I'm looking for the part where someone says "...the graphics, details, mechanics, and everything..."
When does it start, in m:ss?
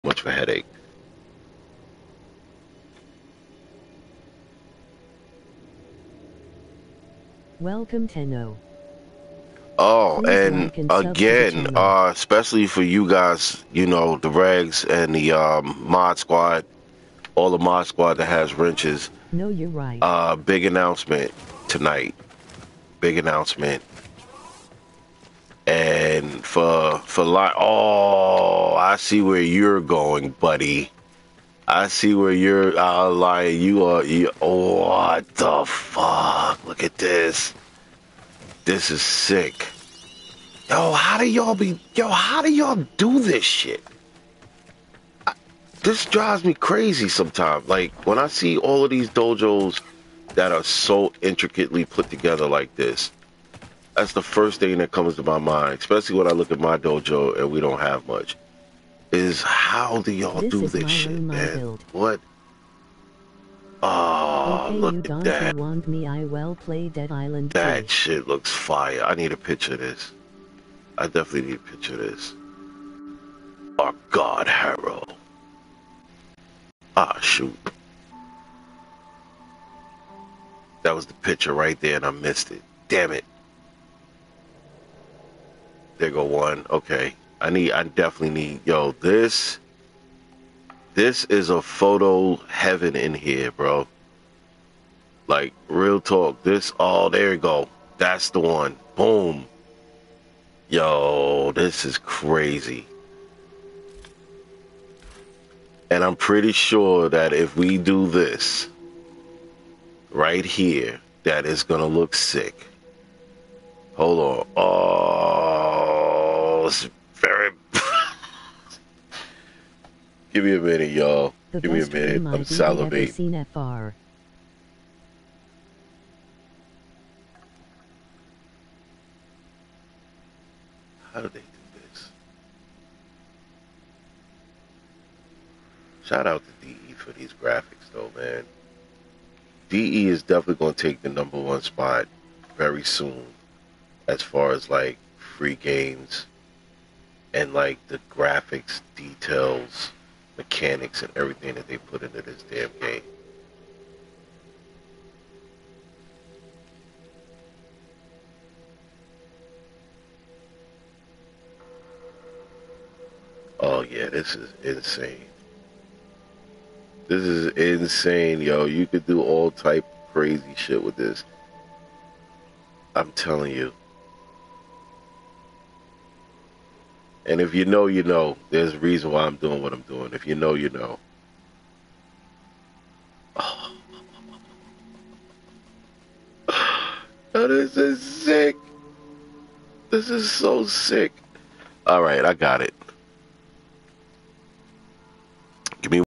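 2:27.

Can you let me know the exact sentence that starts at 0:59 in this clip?
Is how do y'all do this shit, room, man?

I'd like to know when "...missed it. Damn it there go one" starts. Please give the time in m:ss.
1:22.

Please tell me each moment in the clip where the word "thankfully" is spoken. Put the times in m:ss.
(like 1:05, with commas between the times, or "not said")
not said.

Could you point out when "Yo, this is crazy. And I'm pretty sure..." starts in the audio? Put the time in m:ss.
1:40.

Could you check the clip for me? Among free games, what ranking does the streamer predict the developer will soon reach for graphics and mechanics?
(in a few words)
number one spot.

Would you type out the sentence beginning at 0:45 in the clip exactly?
I, this drives me crazy sometimes.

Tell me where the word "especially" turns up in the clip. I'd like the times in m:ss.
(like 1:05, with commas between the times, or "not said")
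0:12, 0:55.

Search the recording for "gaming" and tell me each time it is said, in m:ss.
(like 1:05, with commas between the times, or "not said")
not said.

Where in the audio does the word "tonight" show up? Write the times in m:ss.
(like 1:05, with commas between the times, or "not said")
0:21.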